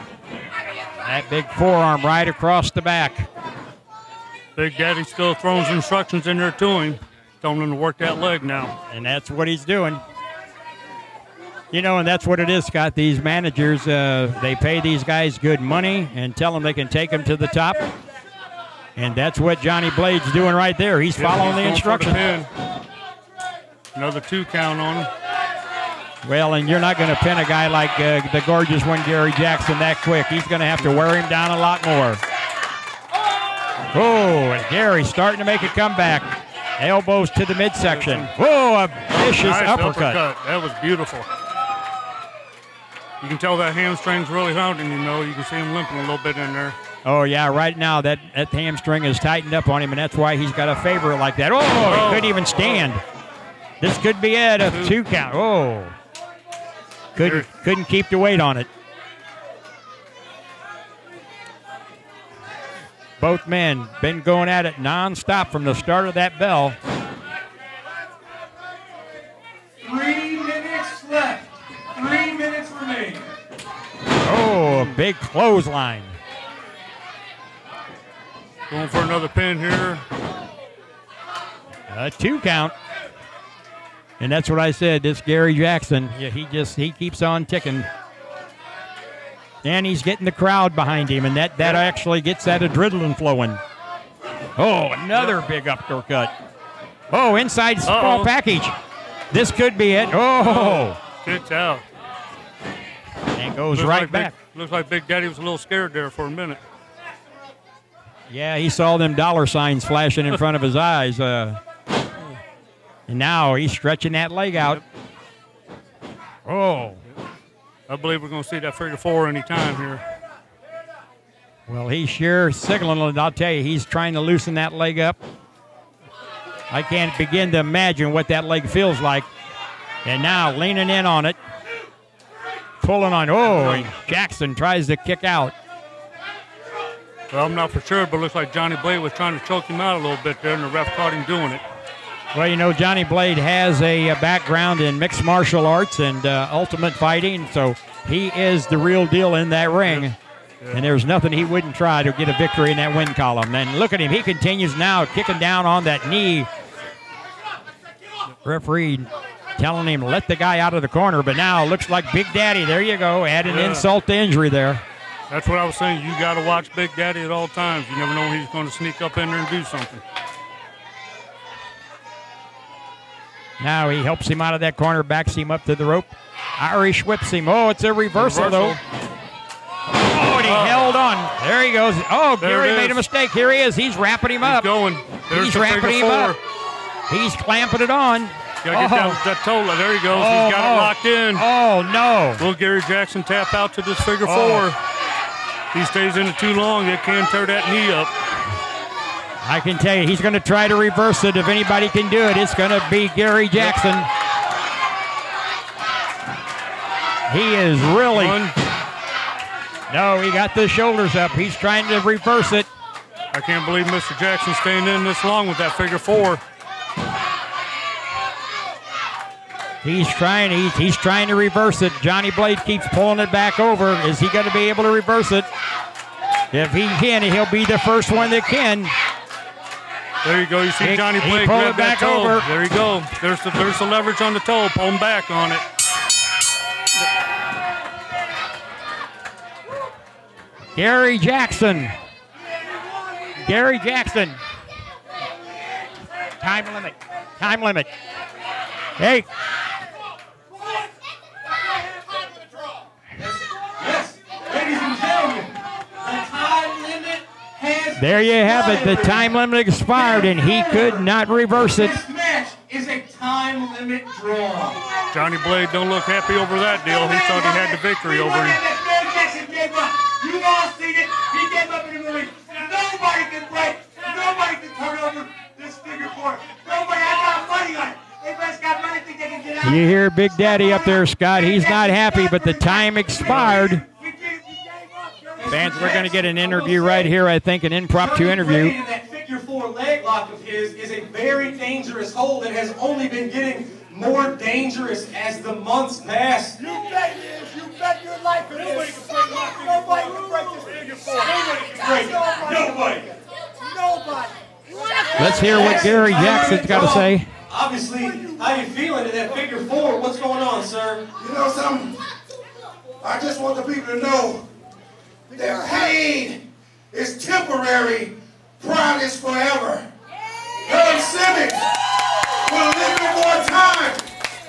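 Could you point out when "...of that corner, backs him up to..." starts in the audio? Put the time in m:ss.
2:54.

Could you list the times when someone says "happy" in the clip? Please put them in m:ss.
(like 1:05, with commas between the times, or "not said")
4:26, 4:41.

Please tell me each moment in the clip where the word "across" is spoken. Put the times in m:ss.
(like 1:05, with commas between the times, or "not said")
0:02.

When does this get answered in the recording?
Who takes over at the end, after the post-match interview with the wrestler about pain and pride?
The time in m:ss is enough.
5:20.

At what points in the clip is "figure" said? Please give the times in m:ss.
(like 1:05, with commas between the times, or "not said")
1:58, 3:14, 3:35, 4:35, 4:49, 5:00, 5:09.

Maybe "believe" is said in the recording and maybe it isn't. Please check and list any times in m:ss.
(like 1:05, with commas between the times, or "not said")
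1:57, 3:33.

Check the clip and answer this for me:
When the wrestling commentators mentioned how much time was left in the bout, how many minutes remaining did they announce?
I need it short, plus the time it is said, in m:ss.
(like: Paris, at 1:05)
3, at 1:11.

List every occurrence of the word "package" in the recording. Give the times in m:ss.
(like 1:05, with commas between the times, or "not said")
1:38.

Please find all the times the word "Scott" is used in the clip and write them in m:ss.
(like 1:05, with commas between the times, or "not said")
0:12, 4:41.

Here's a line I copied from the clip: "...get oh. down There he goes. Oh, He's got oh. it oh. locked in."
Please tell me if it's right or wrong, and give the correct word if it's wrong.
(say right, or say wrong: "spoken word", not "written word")
right.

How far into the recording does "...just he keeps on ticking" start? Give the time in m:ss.
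1:26.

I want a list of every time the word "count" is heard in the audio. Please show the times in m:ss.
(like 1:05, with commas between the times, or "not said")
0:24, 0:55, 1:22.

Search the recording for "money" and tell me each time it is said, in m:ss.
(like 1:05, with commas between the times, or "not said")
0:15, 4:37.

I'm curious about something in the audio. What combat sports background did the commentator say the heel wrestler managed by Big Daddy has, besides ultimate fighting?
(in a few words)
mixed martial arts.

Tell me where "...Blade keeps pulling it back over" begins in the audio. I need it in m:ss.
3:42.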